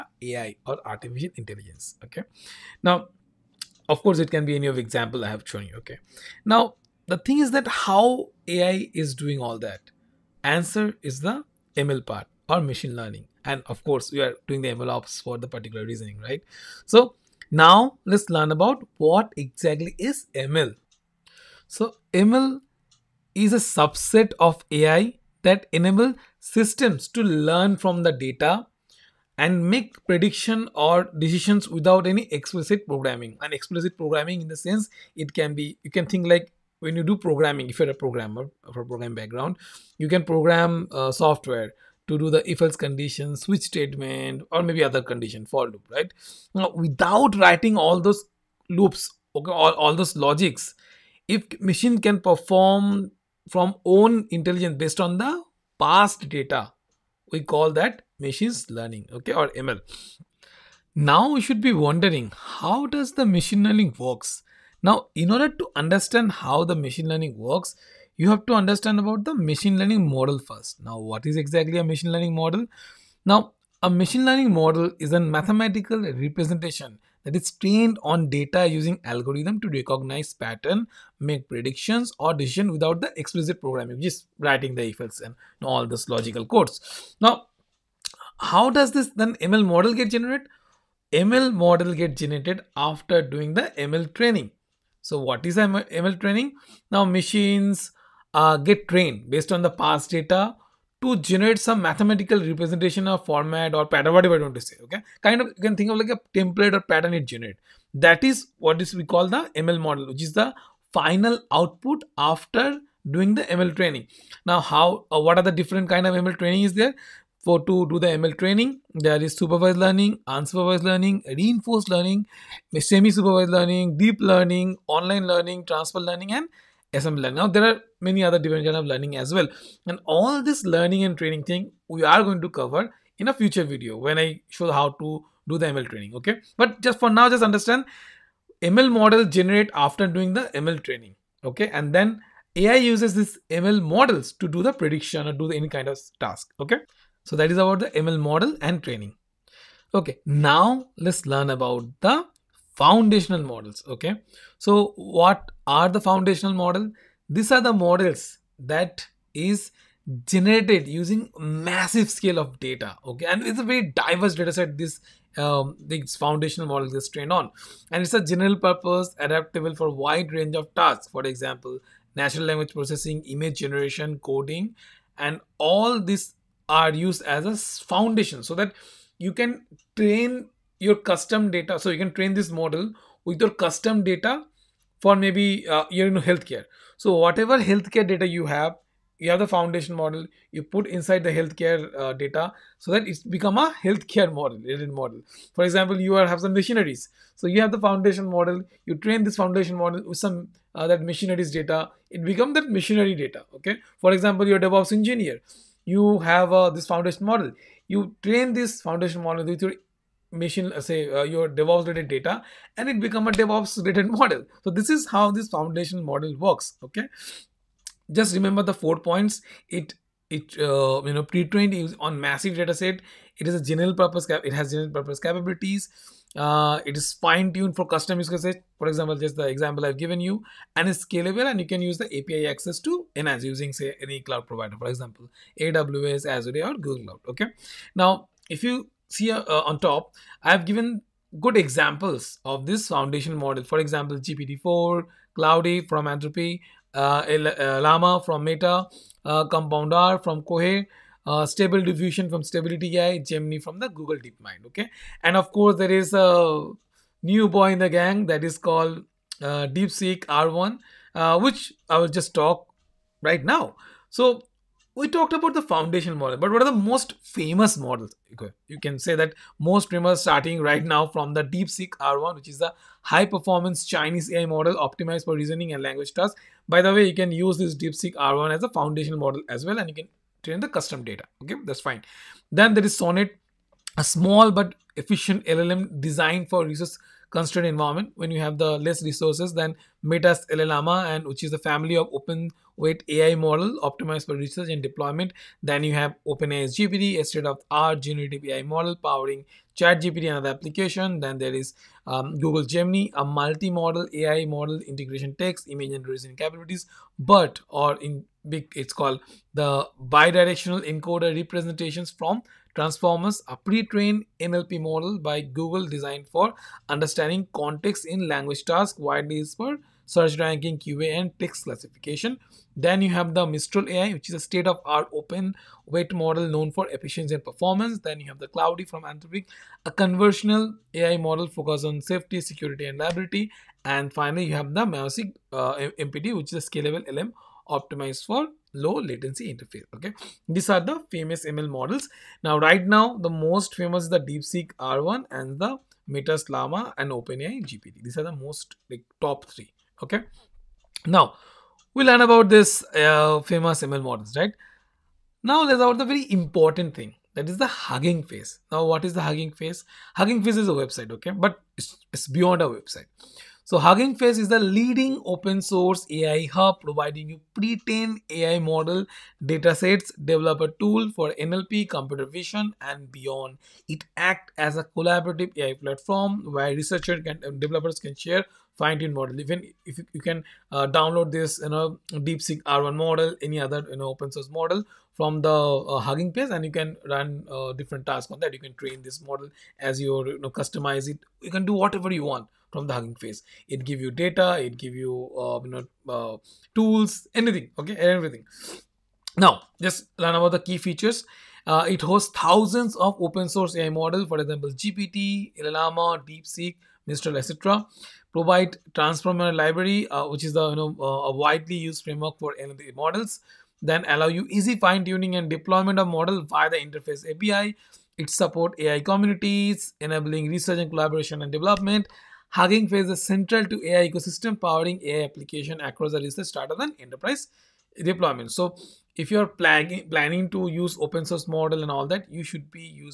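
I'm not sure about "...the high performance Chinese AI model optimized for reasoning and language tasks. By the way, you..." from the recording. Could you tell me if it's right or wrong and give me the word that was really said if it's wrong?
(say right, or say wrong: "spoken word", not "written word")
right.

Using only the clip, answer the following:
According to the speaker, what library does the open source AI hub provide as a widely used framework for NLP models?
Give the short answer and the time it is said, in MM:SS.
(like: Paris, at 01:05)
Transformer library, at 06:48.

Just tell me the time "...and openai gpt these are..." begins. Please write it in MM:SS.
05:46.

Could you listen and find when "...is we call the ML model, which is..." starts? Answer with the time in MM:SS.
01:48.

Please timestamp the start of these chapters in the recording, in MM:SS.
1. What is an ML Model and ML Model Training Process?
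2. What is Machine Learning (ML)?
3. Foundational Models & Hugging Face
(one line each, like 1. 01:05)
1. 01:00
2. 00:15
3. 02:31.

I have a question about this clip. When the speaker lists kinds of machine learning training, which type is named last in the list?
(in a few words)
Ensemble learning.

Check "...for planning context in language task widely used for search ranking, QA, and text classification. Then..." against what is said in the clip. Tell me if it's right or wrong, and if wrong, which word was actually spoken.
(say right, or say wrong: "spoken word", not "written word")
wrong: "understanding", not "planning".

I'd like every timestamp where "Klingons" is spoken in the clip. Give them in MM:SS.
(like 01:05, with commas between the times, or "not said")
not said.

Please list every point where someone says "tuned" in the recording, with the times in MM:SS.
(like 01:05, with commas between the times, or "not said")
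03:47, 06:18.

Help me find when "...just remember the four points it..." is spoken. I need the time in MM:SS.
03:38.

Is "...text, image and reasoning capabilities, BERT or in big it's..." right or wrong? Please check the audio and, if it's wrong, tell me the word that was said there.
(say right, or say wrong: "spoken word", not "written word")
right.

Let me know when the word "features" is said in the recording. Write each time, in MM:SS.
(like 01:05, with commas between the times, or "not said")
06:40.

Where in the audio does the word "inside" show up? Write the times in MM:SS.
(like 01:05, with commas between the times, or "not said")
03:10.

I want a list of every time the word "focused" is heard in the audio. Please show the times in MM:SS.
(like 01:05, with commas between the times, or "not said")
05:31.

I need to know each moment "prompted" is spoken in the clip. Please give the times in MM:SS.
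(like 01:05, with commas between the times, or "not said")
not said.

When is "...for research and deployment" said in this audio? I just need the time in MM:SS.
04:54.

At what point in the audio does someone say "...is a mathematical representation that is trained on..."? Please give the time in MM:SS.
01:14.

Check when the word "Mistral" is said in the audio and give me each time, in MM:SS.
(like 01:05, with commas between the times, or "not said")
05:23, 06:47.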